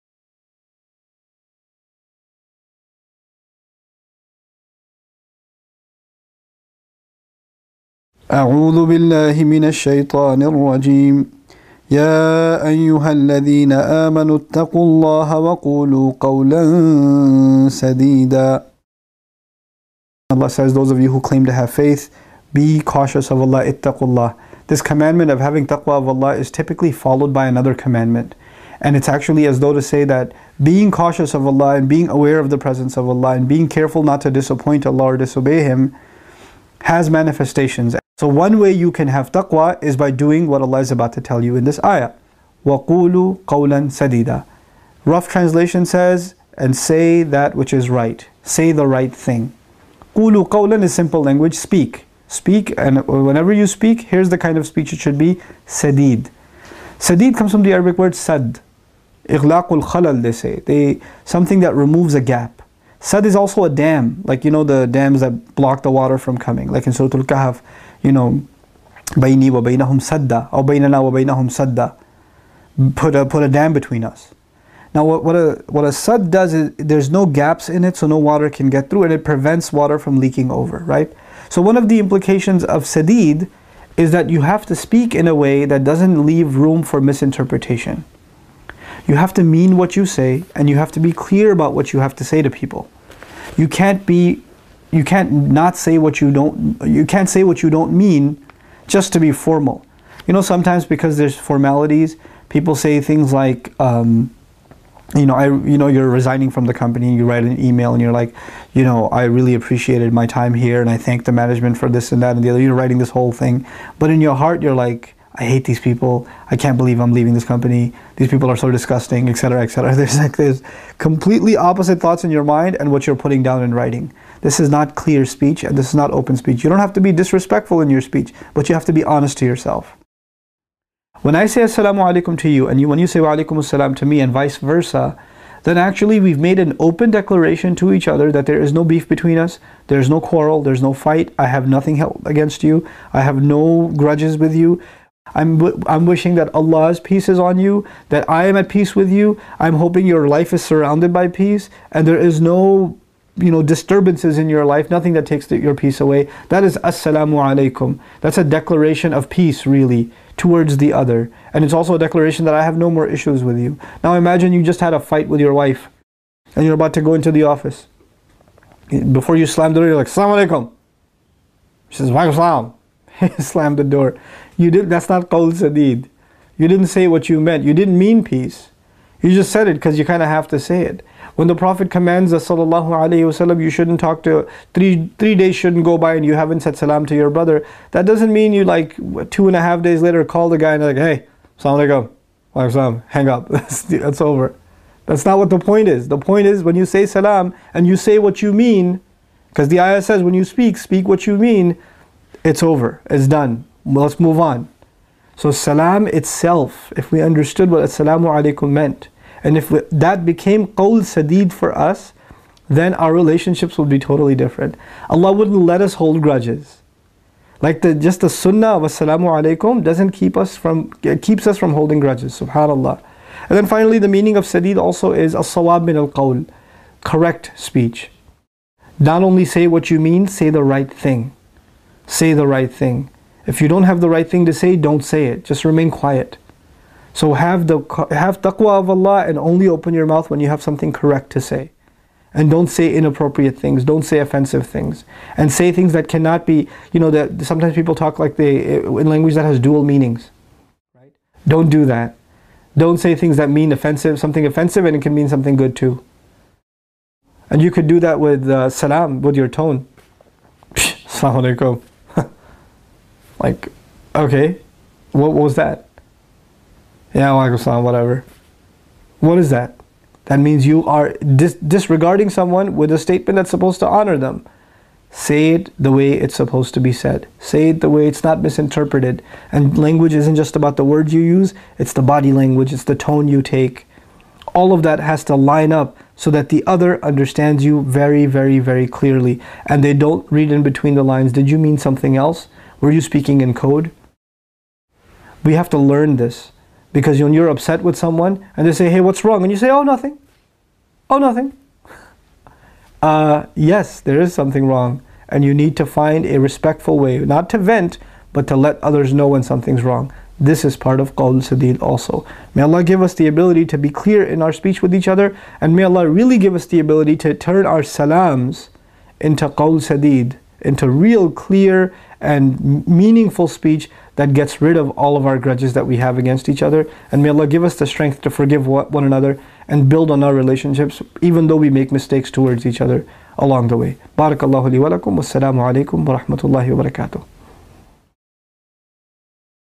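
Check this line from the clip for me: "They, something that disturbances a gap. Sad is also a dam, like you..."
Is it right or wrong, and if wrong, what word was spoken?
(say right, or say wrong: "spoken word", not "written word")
wrong: "removes", not "disturbances".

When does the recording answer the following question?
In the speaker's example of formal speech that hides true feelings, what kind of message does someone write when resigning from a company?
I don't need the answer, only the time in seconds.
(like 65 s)
107 s.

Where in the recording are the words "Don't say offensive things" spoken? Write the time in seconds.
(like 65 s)
243 s.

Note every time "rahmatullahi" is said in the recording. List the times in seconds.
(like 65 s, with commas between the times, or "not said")
336 s.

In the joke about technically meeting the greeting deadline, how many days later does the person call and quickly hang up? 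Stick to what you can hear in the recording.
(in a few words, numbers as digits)
2 and a half.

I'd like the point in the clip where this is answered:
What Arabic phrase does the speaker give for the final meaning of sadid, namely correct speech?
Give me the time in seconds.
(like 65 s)
225 s.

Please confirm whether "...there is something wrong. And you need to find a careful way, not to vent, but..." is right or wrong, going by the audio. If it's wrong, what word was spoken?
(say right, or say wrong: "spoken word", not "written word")
wrong: "respectful", not "careful".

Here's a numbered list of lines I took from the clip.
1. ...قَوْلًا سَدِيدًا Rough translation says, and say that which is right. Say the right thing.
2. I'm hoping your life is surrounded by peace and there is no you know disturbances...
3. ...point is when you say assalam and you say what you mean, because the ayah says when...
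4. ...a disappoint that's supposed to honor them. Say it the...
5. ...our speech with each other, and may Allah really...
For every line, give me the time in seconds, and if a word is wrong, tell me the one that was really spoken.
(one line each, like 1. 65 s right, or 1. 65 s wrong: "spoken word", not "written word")
1. 43 s right
2. 149 s right
3. 196 s wrong: "salam", not "assalam"
4. 272 s wrong: "statement", not "disappoint"
5. 314 s right.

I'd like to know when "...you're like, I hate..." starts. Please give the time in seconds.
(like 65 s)
114 s.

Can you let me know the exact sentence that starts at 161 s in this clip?
And it's also a declaration that I have no more issues with you.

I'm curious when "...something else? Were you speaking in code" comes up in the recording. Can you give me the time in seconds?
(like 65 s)
291 s.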